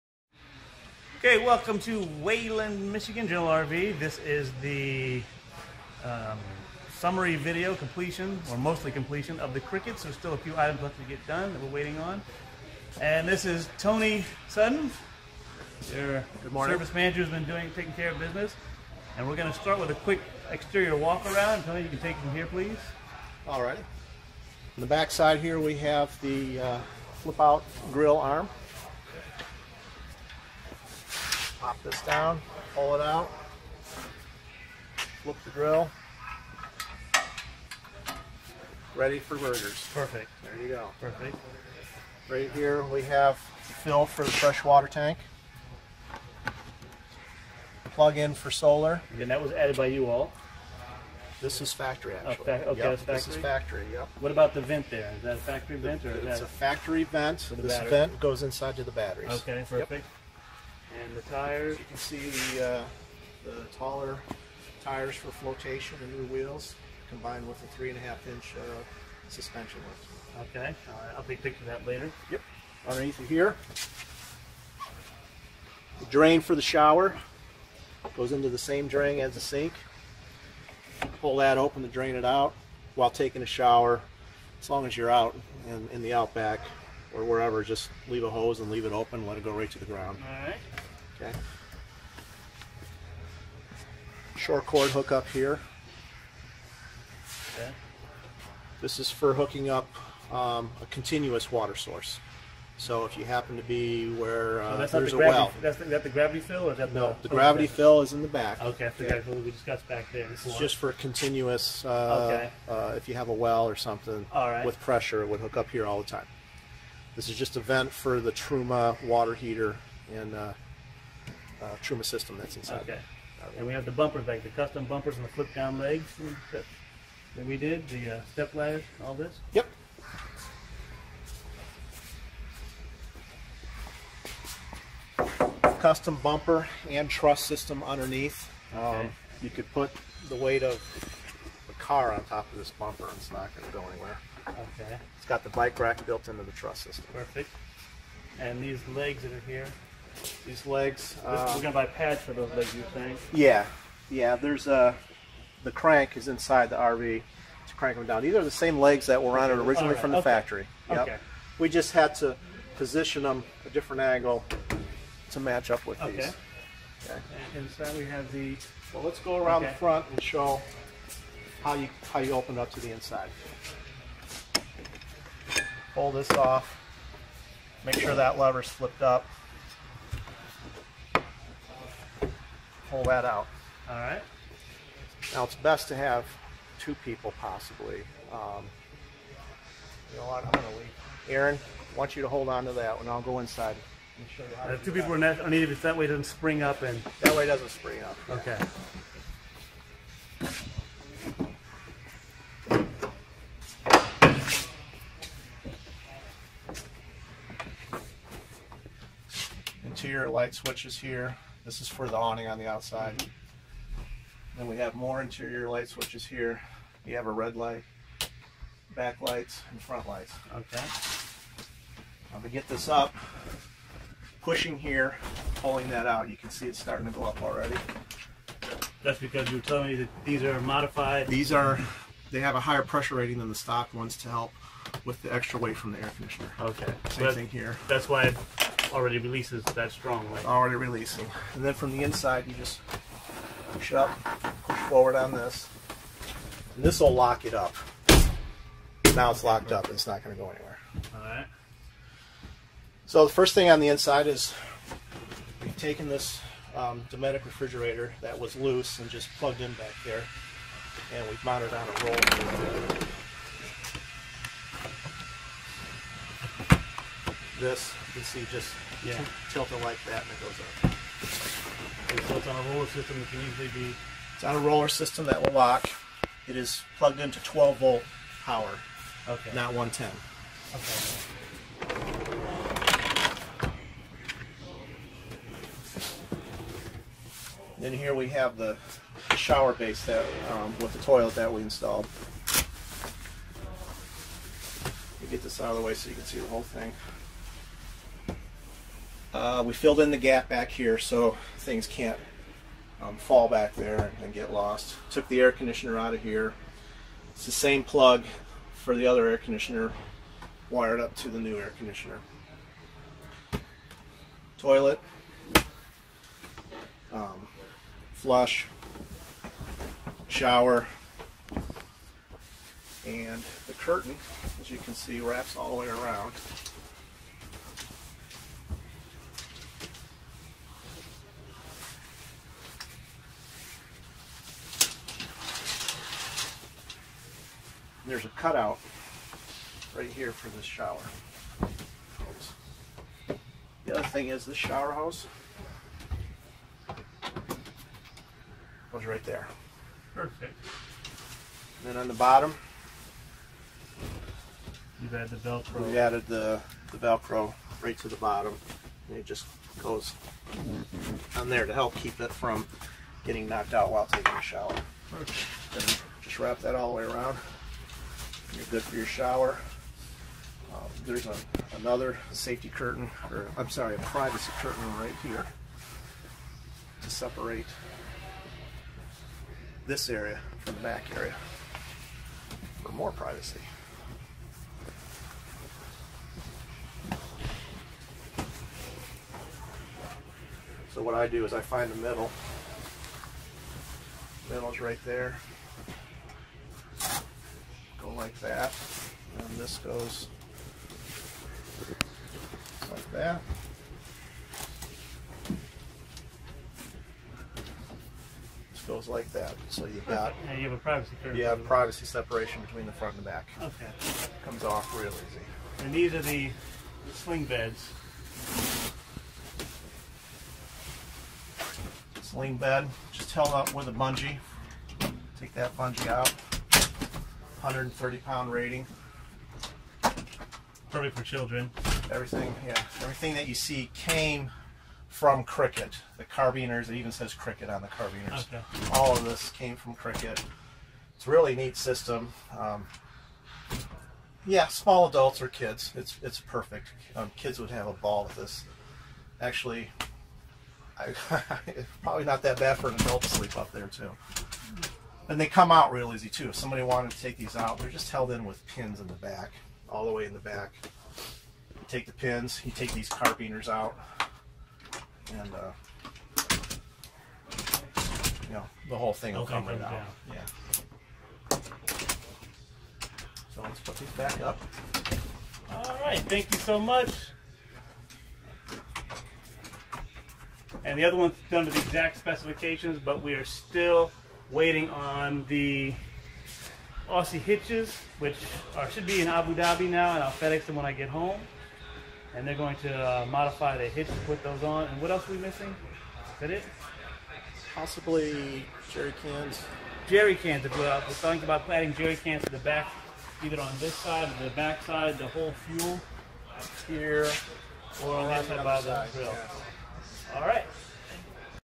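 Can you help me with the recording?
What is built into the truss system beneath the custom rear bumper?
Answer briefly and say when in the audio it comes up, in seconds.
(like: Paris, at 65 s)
bike rack, at 145 s.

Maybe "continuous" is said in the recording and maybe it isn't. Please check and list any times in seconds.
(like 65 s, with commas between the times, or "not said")
100 s, 110 s.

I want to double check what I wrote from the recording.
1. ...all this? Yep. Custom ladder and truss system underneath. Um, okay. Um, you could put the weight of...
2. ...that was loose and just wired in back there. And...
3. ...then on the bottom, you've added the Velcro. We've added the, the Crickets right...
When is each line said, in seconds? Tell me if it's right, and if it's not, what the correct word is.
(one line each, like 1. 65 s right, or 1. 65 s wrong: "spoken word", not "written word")
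1. 129 s wrong: "bumper", not "ladder"
2. 258 s wrong: "plugged", not "wired"
3. 351 s wrong: "Velcro", not "Crickets".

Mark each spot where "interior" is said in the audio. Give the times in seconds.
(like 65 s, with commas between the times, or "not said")
209 s, 215 s.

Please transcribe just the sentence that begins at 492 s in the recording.
And they're going to uh, modify the hitch and put those on.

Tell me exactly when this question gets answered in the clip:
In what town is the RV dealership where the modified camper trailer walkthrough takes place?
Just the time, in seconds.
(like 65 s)
2 s.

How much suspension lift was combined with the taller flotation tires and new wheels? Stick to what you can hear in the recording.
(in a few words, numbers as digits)
3.5 inch.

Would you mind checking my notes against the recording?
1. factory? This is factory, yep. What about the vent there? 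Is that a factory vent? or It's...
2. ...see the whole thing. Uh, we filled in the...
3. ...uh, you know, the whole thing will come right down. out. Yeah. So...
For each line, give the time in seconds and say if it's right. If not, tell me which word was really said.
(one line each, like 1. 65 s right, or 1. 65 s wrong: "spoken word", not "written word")
1. 52 s right
2. 296 s right
3. 465 s right.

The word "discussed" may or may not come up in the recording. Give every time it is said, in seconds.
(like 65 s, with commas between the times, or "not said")
109 s.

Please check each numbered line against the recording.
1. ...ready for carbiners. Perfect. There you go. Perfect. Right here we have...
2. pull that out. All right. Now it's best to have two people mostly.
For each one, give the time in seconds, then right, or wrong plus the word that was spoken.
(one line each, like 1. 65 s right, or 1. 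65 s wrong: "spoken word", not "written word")
1. 38 s wrong: "burgers", not "carbiners"
2. 182 s wrong: "possibly", not "mostly".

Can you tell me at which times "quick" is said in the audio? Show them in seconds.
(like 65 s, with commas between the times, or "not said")
20 s.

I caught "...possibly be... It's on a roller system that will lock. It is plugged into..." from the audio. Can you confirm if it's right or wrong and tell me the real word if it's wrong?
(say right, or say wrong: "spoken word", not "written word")
wrong: "easily", not "possibly".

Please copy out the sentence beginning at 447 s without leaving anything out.
Um, kids would have a ball with this.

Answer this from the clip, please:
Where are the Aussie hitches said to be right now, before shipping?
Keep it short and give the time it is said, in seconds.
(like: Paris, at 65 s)
Abu Dhabi, at 489 s.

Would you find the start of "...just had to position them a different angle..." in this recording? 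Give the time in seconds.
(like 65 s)
161 s.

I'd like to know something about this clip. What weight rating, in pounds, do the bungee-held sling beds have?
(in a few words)
130.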